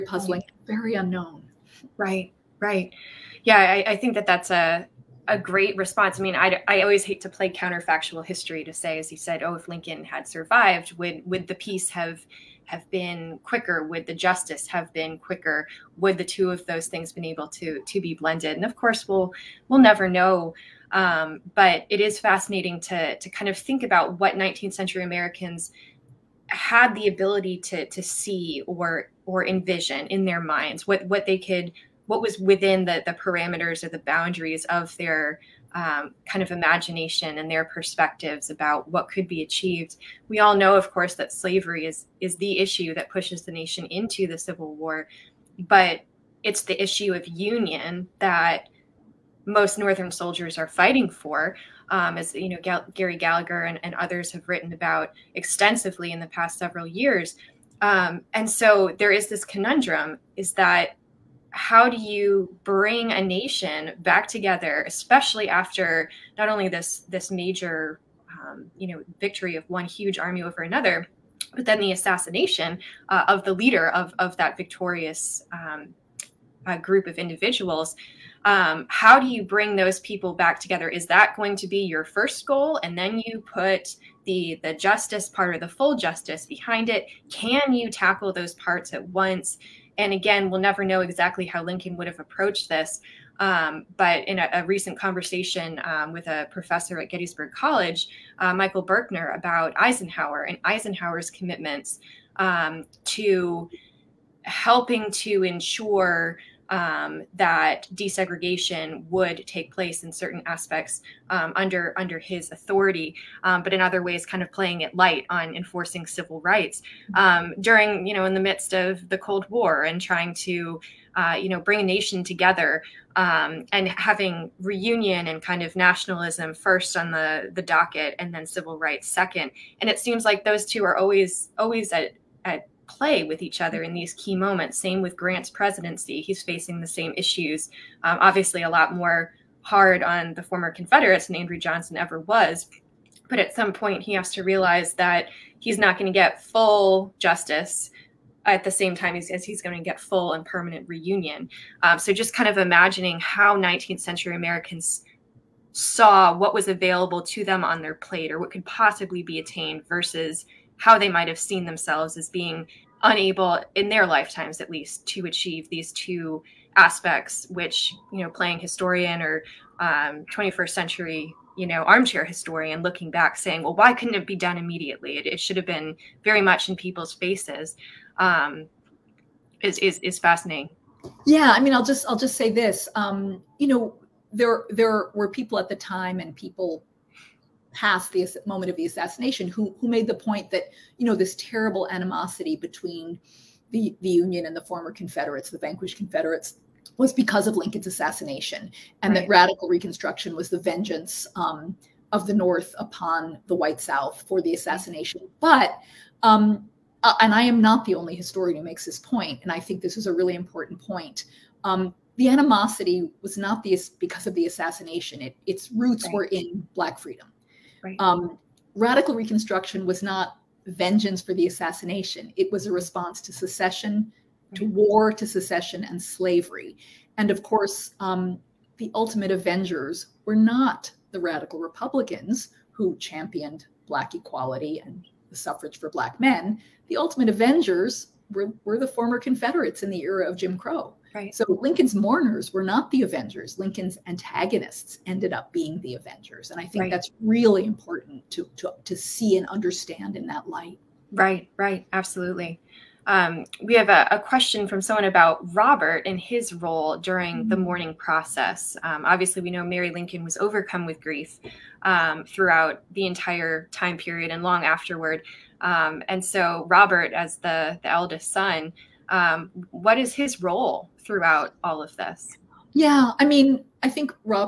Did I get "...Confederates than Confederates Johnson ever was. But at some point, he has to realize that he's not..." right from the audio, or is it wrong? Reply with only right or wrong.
wrong.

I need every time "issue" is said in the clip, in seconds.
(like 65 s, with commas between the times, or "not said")
42 s, 46 s, 137 s.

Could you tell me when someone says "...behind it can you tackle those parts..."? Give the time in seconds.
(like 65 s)
86 s.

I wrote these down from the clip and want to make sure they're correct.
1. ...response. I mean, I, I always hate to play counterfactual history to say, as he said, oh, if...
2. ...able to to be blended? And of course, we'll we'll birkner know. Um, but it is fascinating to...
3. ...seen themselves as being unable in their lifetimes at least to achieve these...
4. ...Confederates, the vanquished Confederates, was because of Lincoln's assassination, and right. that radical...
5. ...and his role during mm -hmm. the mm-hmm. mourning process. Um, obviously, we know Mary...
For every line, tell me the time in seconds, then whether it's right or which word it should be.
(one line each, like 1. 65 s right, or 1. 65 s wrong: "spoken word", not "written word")
1. 5 s right
2. 17 s wrong: "never", not "birkner"
3. 161 s right
4. 194 s right
5. 256 s right.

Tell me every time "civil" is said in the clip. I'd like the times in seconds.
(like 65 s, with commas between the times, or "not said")
44 s, 116 s, 128 s.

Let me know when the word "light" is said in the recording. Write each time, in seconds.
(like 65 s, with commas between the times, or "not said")
114 s, 250 s.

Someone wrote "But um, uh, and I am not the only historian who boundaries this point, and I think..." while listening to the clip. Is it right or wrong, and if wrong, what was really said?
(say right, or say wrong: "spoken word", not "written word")
wrong: "makes", not "boundaries".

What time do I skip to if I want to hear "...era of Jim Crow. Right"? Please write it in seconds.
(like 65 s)
240 s.